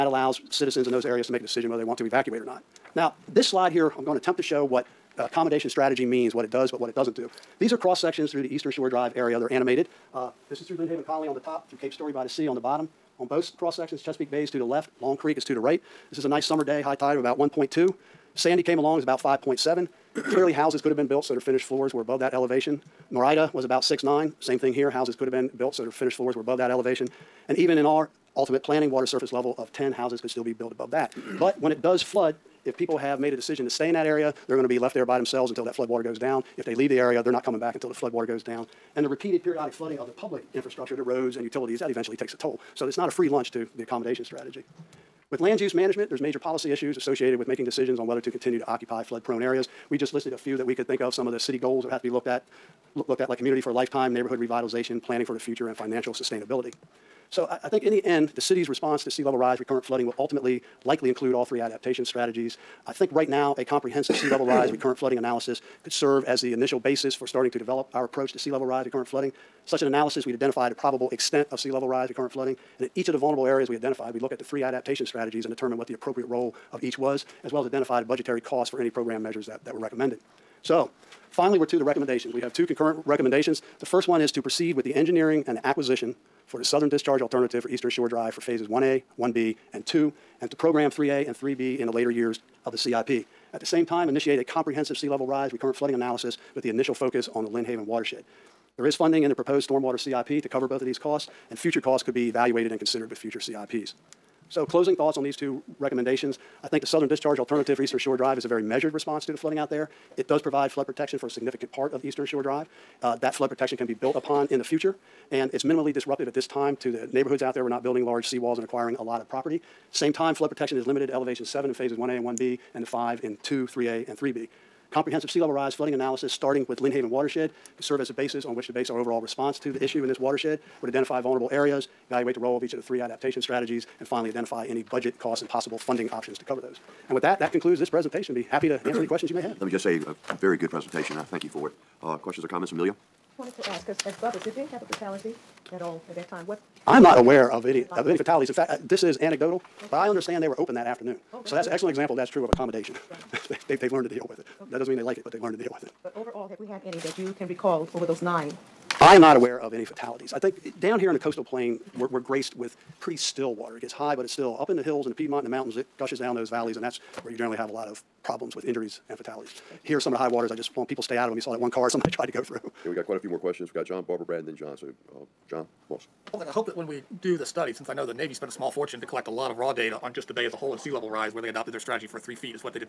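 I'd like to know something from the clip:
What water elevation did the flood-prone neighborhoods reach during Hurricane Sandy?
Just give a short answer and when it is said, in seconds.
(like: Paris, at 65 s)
5.7, at 19 s.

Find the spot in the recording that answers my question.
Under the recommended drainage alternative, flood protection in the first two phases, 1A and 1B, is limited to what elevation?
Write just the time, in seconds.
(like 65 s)
121 s.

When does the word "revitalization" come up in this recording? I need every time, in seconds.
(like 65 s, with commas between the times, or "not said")
54 s.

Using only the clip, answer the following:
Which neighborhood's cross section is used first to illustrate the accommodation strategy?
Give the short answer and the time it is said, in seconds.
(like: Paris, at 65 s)
Lynnhaven Colony, at 10 s.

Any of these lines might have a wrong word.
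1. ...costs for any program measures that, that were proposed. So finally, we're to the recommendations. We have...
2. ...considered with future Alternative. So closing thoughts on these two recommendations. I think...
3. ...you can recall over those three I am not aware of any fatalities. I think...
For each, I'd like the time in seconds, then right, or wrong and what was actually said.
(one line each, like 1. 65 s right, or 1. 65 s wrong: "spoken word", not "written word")
1. 78 s wrong: "recommended", not "proposed"
2. 102 s wrong: "CIPs", not "Alternative"
3. 157 s wrong: "nine", not "three".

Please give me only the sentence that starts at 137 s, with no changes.
And with that, that concludes this presentation.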